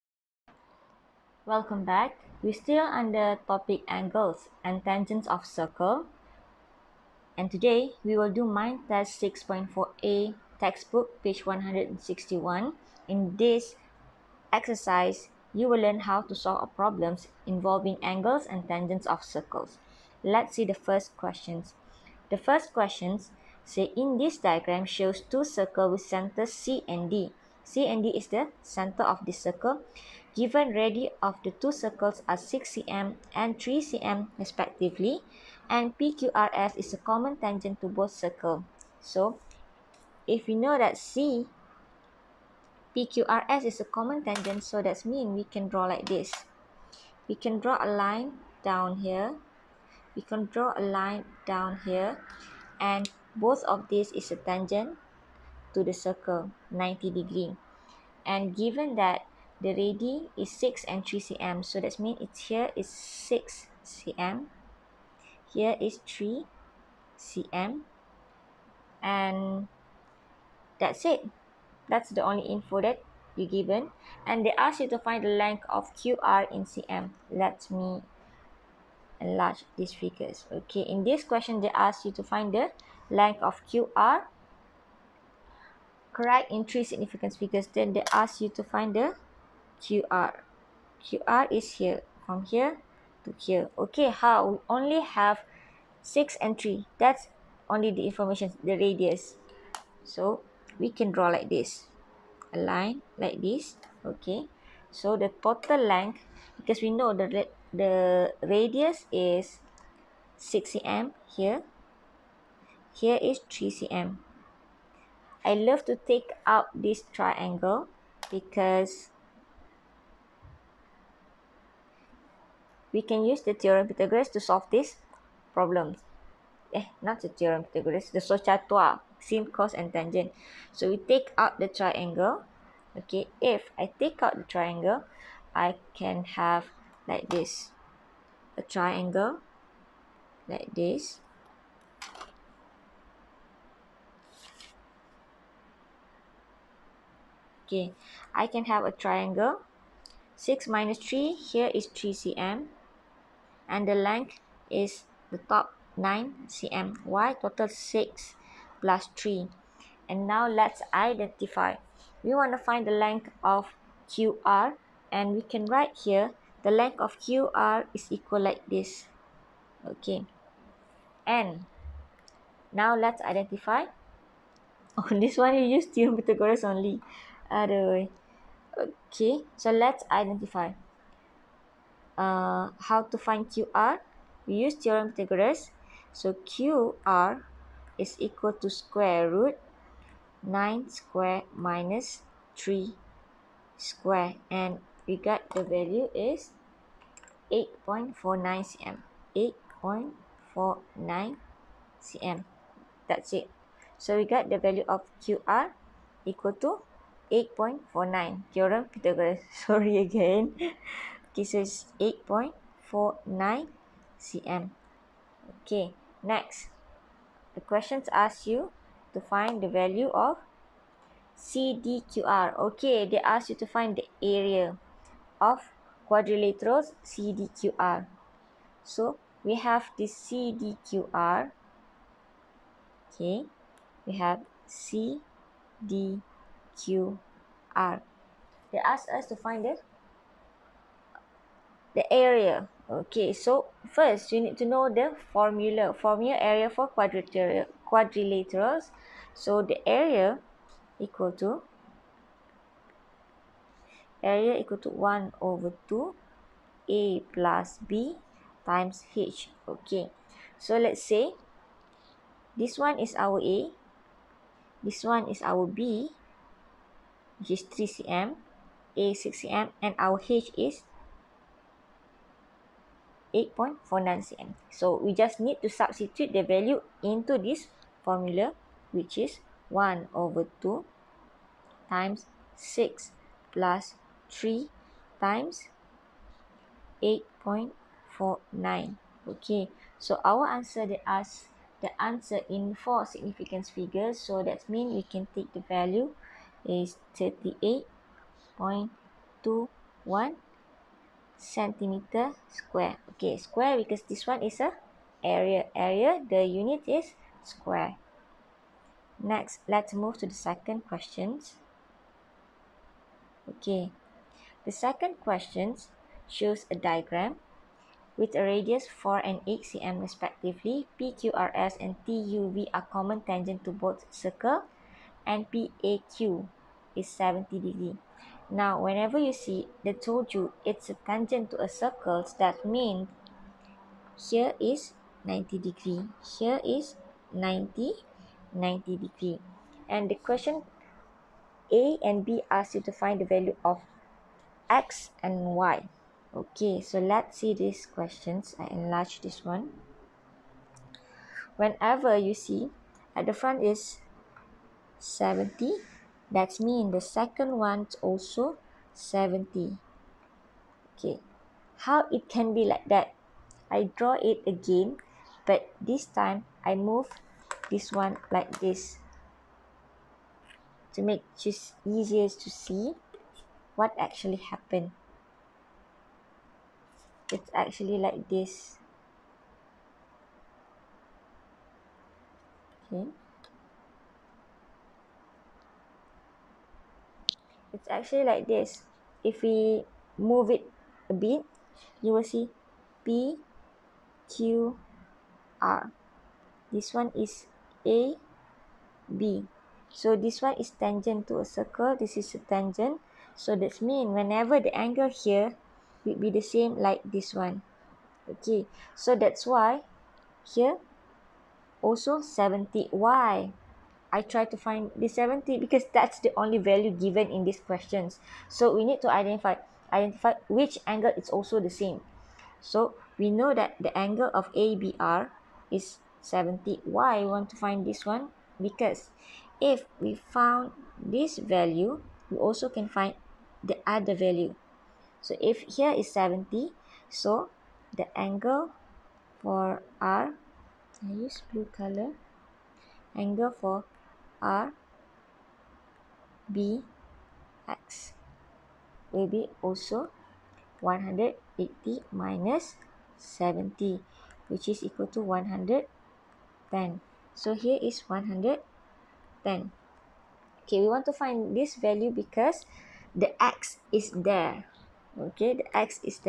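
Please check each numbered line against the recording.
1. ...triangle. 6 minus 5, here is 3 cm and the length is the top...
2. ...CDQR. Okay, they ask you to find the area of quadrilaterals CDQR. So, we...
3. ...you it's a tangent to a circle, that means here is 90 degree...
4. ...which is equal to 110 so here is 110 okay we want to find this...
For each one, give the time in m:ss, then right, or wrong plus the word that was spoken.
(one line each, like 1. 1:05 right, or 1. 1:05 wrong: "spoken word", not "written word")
1. 2:28 wrong: "3", not "5"
2. 3:41 right
3. 5:30 right
4. 7:34 right.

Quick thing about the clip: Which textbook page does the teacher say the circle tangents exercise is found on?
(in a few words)
161.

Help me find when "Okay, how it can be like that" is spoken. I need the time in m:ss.
6:00.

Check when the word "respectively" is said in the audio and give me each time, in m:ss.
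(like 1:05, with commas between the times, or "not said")
0:34, 5:20.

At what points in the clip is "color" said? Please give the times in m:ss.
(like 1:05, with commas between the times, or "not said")
7:21.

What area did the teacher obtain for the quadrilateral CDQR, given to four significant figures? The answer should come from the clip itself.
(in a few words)
38.21 square centimetres.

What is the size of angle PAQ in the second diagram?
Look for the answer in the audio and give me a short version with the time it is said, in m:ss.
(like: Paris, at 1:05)
70 degrees, at 5:27.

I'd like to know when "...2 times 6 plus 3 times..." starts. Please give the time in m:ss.
4:40.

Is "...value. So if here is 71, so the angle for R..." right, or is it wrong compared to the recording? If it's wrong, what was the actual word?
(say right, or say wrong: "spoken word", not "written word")
wrong: "70", not "71".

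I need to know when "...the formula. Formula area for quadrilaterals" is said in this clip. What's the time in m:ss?
4:04.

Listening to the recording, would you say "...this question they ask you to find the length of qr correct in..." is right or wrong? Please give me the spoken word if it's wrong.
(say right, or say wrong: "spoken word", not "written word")
right.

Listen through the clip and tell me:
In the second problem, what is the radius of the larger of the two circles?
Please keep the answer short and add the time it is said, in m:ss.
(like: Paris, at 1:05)
8 cm, at 5:19.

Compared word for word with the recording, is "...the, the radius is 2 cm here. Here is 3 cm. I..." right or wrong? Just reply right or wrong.
wrong.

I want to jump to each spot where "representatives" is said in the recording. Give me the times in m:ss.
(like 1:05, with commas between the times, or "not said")
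not said.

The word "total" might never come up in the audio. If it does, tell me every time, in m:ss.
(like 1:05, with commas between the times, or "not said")
1:45, 2:37.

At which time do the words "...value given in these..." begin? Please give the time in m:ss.
6:56.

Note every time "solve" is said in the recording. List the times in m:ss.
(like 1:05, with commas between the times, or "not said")
0:16, 2:04.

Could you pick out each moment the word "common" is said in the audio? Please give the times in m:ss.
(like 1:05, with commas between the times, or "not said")
0:36, 0:43, 5:22.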